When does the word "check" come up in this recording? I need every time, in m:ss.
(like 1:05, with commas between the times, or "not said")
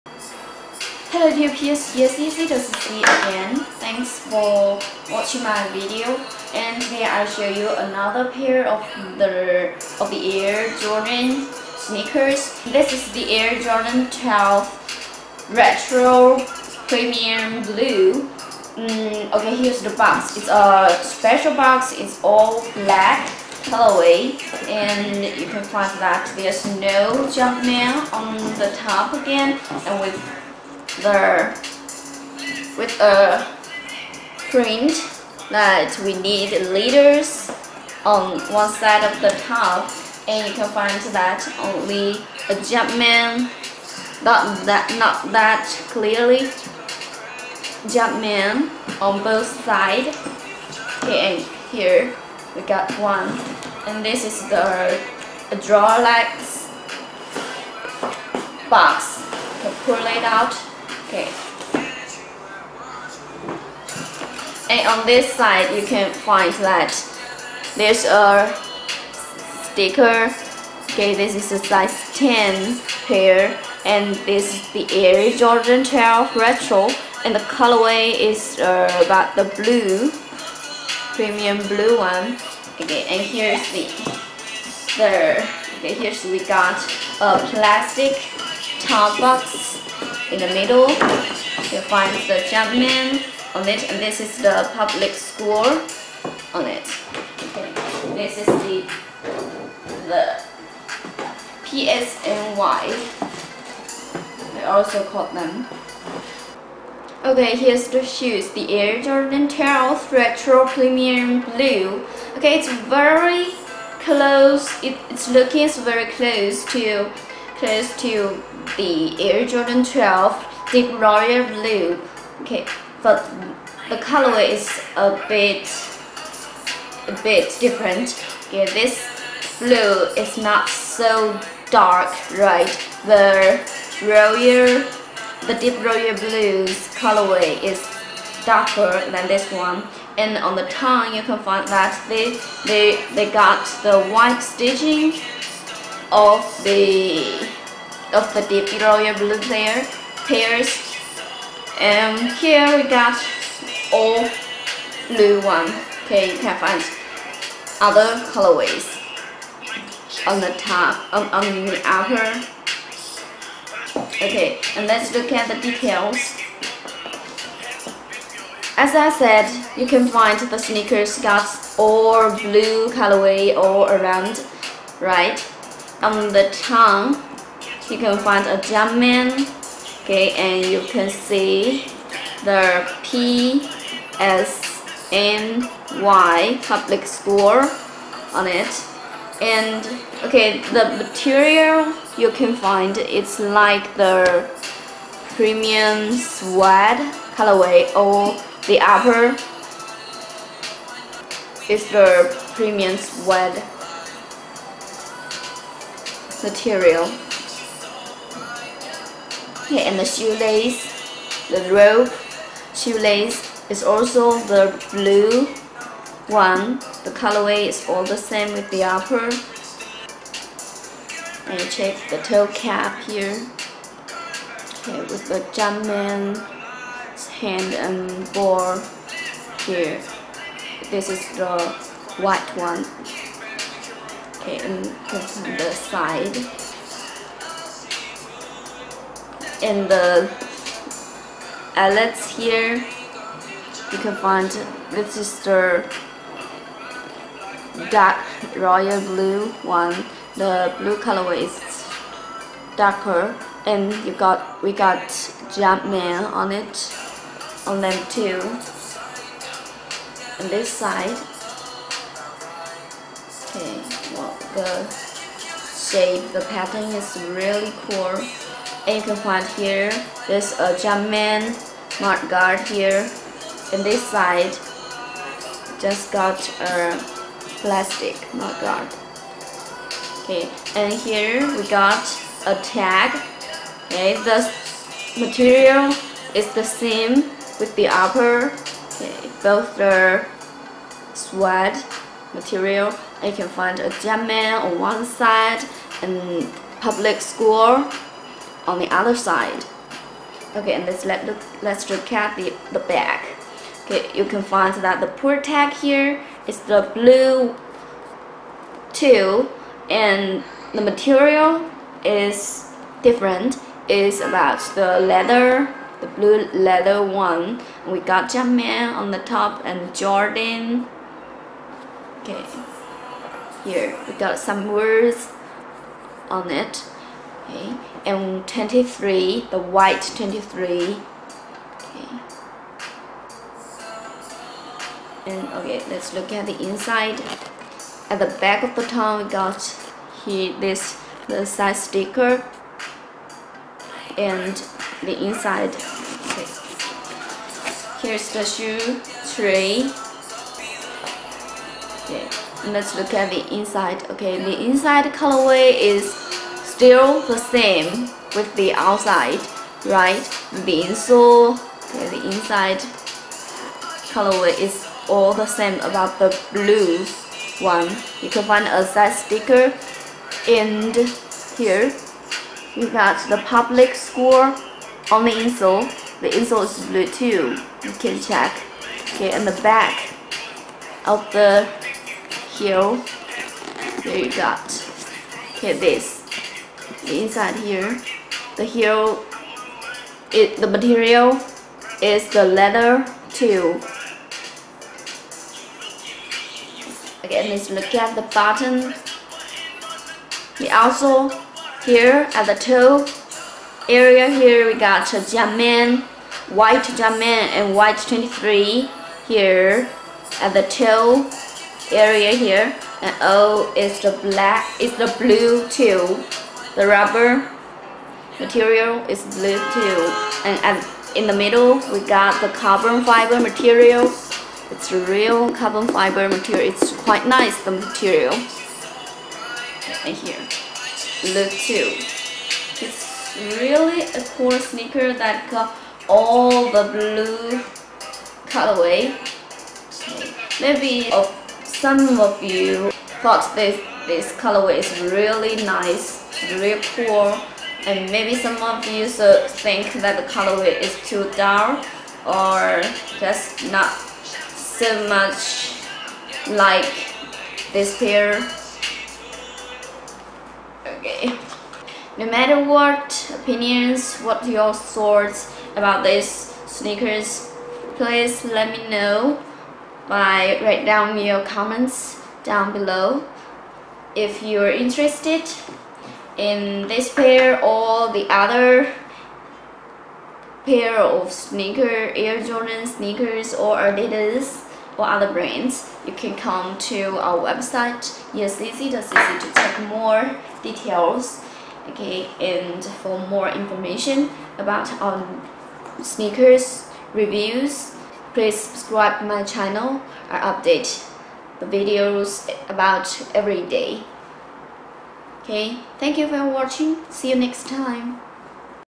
3:41, 6:18, 8:08.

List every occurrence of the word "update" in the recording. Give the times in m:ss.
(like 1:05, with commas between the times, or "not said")
8:20.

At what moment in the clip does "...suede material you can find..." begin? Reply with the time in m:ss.
4:51.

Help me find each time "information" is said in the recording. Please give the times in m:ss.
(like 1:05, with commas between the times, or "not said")
8:13.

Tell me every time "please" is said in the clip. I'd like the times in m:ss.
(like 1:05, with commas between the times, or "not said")
7:47, 8:18.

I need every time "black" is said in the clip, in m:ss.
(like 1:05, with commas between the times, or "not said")
0:22, 6:54.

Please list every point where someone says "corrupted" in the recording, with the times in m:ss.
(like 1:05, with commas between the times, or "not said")
not said.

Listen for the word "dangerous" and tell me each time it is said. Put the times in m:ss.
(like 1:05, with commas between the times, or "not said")
not said.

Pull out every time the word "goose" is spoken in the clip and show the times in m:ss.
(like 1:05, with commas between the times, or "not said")
not said.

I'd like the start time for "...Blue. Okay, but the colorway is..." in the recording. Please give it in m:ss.
2:01.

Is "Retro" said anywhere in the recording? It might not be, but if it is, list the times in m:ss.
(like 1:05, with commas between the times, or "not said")
0:15, 1:16, 1:50.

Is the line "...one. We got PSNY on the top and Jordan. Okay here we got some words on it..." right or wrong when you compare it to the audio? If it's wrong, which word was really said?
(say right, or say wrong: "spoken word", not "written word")
wrong: "Japan", not "PSNY".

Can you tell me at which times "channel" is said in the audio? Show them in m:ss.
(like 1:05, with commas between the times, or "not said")
8:19.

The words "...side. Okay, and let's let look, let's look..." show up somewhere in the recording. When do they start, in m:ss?
4:59.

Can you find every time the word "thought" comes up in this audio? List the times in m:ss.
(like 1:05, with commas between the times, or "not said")
7:23, 7:44.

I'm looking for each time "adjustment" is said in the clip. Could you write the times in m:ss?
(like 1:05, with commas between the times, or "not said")
0:42, 0:47.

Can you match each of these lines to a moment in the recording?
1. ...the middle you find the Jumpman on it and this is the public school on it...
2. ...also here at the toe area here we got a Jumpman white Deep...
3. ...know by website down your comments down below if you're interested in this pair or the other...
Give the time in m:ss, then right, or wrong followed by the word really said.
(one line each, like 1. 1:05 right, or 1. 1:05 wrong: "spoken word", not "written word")
1. 1:30 right
2. 6:40 wrong: "Jumpman", not "Deep"
3. 7:48 wrong: "write", not "website".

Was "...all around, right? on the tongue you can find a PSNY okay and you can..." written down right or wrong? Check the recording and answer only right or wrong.
wrong.